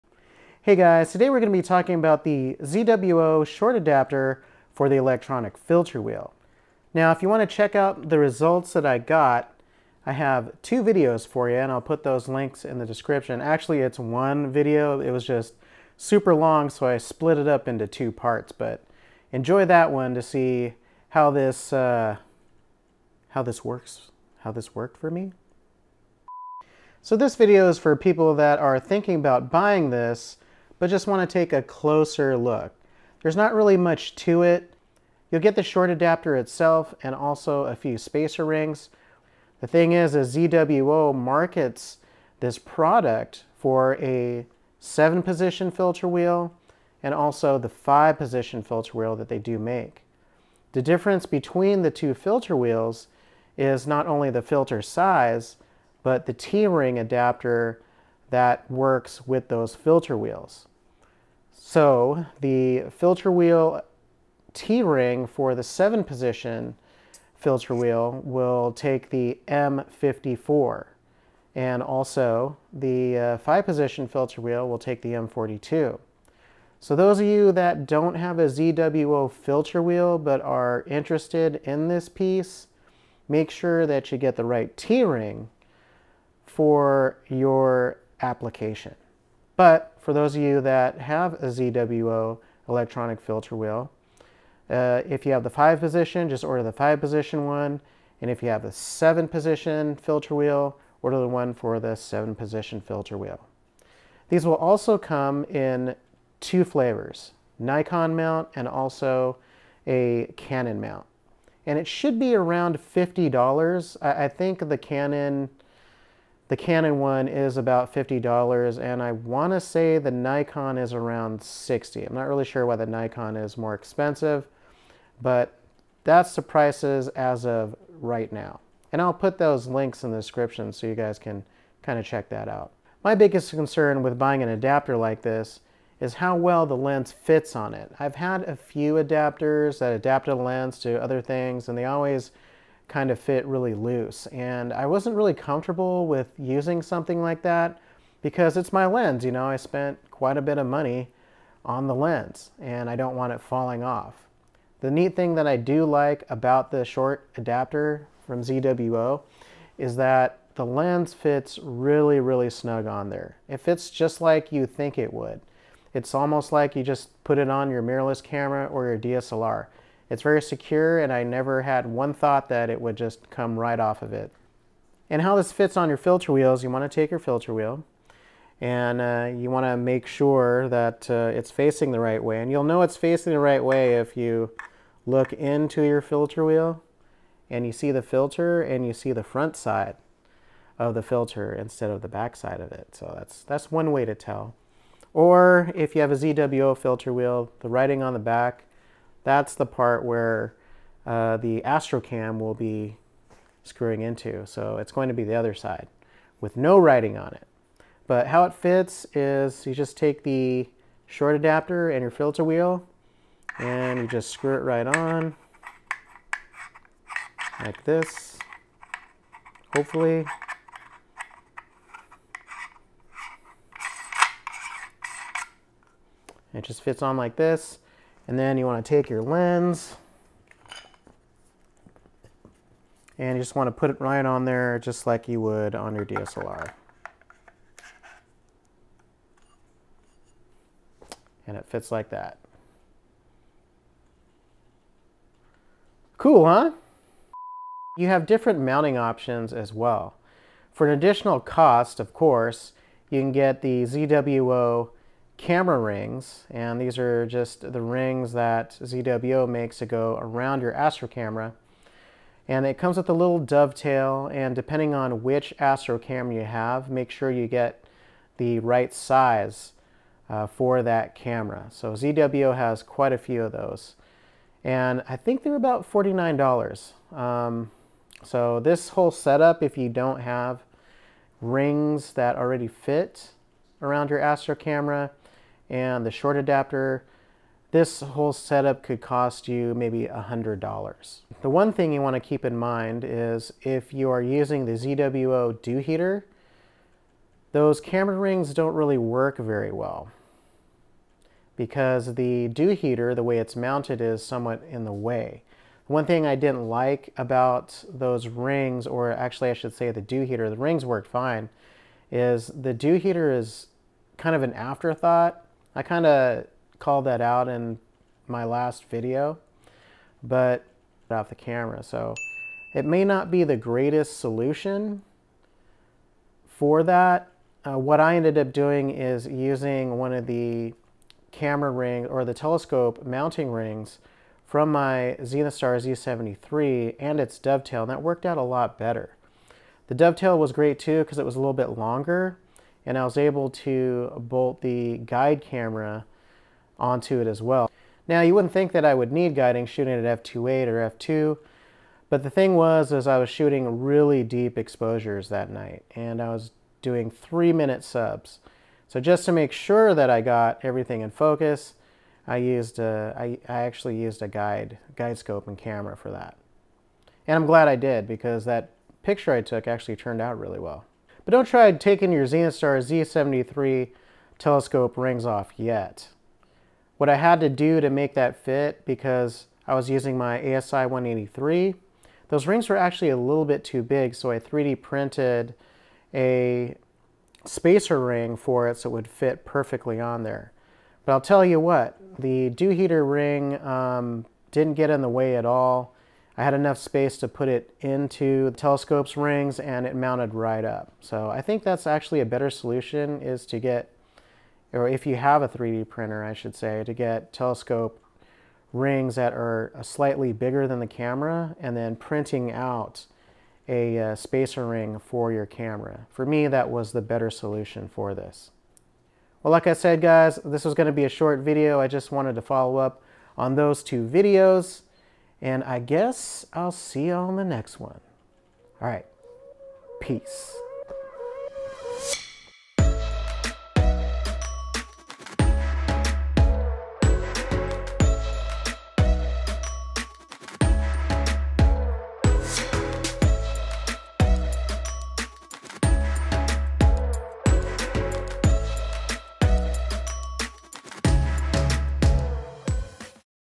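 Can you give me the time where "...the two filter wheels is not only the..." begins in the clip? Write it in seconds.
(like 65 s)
51 s.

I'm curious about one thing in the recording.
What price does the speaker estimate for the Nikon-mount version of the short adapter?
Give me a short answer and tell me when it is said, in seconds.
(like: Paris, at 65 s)
$60, at 121 s.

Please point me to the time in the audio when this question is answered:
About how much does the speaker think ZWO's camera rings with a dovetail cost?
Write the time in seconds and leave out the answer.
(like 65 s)
275 s.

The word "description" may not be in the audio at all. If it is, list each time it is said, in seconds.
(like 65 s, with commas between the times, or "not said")
12 s, 130 s.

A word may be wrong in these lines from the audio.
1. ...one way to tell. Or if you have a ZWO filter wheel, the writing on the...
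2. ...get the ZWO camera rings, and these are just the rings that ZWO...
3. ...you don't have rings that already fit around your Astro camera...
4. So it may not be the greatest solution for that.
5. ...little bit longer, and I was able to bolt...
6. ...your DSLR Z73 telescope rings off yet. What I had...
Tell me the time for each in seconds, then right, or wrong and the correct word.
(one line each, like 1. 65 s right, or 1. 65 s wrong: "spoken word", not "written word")
1. 193 s right
2. 253 s right
3. 279 s right
4. 321 s right
5. 341 s right
6. 372 s wrong: "Zenithstar", not "DSLR".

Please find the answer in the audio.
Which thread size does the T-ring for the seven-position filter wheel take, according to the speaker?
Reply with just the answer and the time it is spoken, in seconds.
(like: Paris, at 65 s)
M54, at 69 s.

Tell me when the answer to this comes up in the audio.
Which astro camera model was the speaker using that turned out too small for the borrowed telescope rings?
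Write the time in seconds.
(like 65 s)
380 s.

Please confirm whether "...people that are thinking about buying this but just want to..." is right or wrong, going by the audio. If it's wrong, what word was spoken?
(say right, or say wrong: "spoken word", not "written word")
right.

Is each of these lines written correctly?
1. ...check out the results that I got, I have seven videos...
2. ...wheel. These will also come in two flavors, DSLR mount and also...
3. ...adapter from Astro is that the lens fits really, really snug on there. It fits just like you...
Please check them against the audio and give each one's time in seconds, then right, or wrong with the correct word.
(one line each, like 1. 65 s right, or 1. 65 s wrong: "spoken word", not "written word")
1. 7 s wrong: "two", not "seven"
2. 103 s wrong: "Nikon", not "DSLR"
3. 157 s wrong: "ZWO", not "Astro".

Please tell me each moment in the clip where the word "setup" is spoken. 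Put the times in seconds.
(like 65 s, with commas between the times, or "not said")
279 s, 288 s.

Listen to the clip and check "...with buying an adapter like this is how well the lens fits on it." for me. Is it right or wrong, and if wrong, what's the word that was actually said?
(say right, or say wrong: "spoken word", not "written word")
right.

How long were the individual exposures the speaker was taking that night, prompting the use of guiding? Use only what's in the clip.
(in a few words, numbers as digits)
3 minutes.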